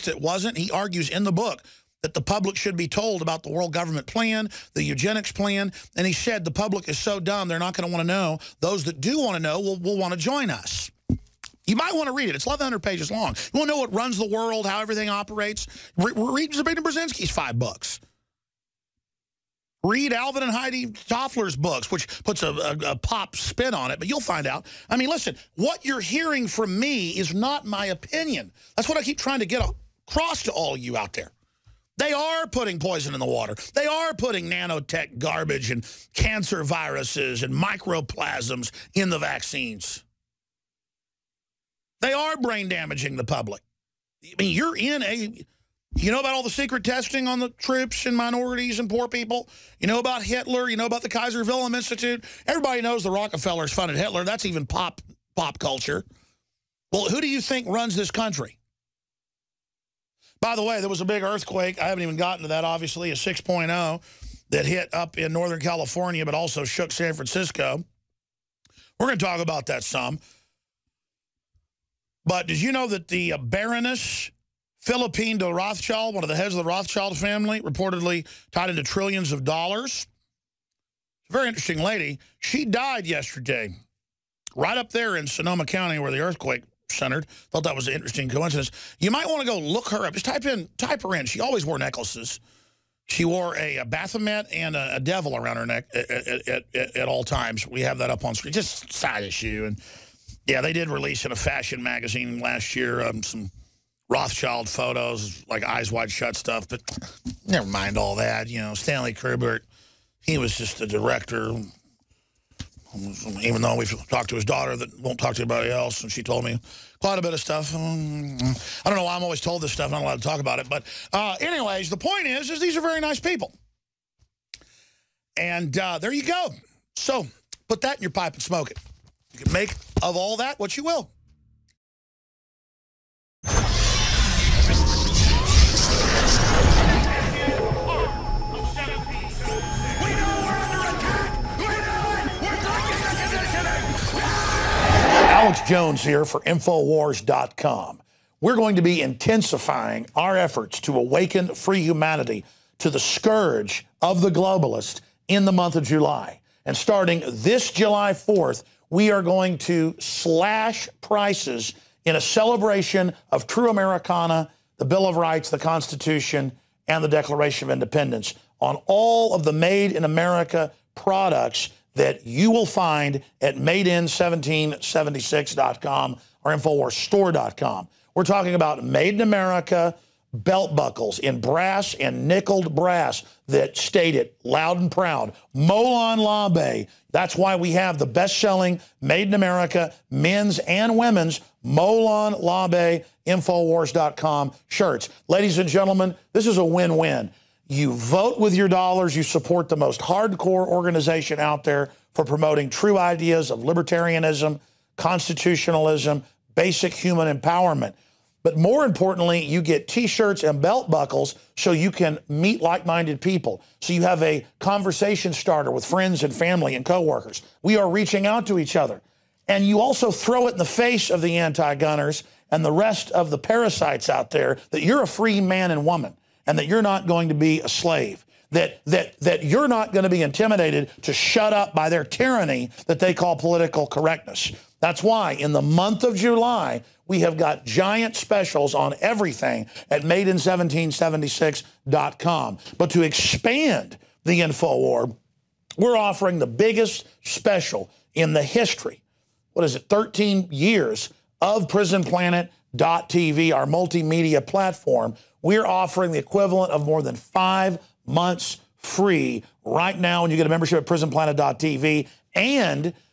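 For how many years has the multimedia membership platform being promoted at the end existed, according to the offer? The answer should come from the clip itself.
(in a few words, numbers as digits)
13.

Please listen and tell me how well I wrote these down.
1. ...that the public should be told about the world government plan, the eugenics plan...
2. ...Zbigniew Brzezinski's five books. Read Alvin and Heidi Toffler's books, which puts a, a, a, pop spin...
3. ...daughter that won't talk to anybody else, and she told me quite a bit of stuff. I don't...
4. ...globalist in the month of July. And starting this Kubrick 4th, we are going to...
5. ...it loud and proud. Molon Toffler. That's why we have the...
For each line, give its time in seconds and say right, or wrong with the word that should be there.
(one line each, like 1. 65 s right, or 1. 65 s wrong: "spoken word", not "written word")
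1. 2 s right
2. 16 s right
3. 114 s right
4. 154 s wrong: "July", not "Kubrick"
5. 184 s wrong: "Labe", not "Toffler".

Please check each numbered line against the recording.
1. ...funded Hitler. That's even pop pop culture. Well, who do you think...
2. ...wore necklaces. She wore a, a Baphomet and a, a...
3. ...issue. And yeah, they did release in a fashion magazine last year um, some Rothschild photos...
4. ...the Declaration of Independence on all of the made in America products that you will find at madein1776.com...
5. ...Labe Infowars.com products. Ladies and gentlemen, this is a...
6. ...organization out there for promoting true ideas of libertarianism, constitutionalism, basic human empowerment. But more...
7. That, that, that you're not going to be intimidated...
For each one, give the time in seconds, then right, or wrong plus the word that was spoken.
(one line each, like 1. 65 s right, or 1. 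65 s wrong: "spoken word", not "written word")
1. 53 s right
2. 91 s right
3. 99 s right
4. 167 s right
5. 192 s wrong: "shirts", not "products"
6. 200 s right
7. 228 s right.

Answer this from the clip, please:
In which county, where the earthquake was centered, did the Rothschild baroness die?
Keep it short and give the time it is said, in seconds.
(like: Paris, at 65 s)
Sonoma County, at 85 s.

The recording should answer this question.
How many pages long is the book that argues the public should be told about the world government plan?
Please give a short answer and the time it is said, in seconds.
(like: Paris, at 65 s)
1,100, at 12 s.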